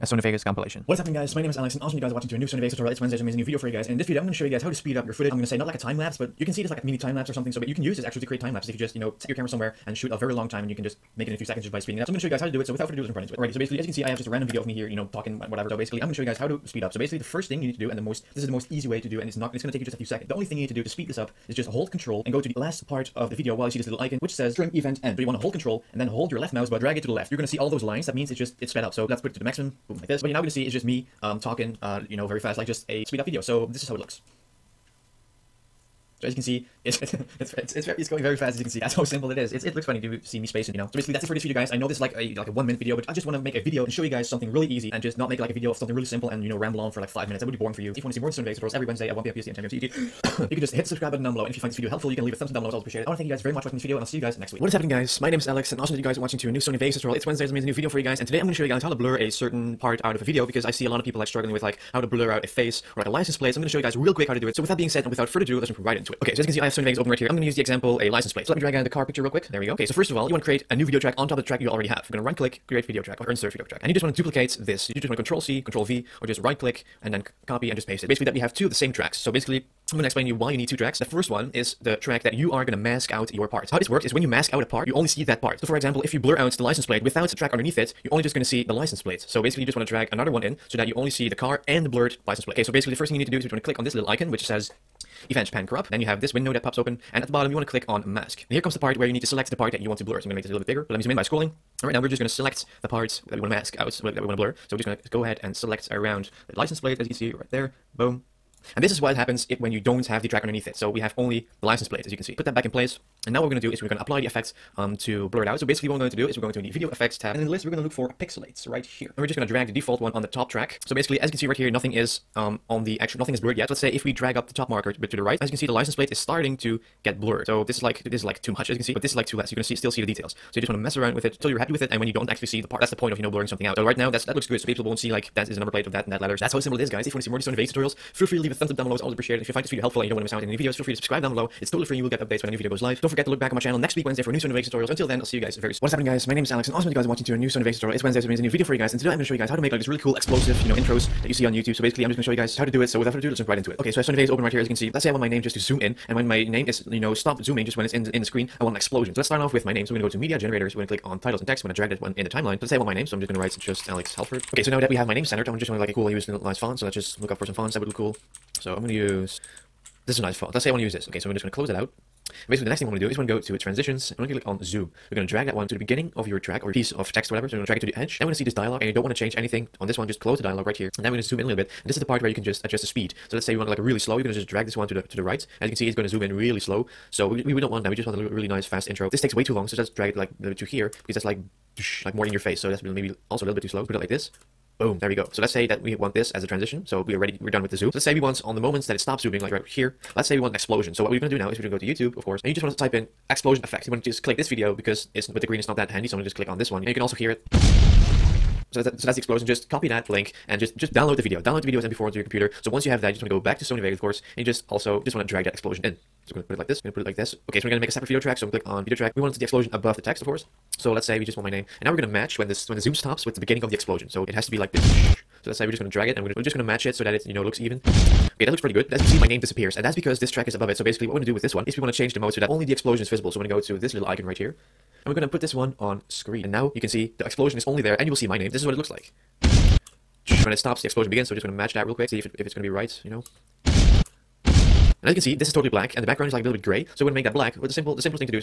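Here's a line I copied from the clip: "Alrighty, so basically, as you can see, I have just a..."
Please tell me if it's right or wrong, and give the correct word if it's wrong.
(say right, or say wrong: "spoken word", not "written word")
right.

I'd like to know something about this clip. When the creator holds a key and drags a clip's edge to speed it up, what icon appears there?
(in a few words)
trim event end.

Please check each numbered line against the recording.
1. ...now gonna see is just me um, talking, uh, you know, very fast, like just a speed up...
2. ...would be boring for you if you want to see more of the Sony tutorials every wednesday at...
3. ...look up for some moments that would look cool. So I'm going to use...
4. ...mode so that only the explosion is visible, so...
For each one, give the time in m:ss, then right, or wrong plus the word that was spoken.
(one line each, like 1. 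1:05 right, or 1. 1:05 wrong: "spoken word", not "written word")
1. 0:30 right
2. 0:47 right
3. 2:47 wrong: "fonts", not "moments"
4. 3:52 right.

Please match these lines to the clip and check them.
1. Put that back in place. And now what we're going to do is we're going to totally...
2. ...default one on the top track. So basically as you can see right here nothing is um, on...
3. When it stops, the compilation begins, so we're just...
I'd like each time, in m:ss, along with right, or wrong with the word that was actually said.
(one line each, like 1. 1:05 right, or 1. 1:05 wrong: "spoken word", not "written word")
1. 1:52 wrong: "apply", not "totally"
2. 1:59 right
3. 4:00 wrong: "explosion", not "compilation".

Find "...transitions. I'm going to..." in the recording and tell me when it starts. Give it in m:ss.
2:53.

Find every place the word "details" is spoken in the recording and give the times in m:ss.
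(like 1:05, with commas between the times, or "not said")
2:10.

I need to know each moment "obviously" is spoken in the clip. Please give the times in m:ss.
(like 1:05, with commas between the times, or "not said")
not said.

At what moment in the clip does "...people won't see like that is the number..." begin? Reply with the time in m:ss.
2:14.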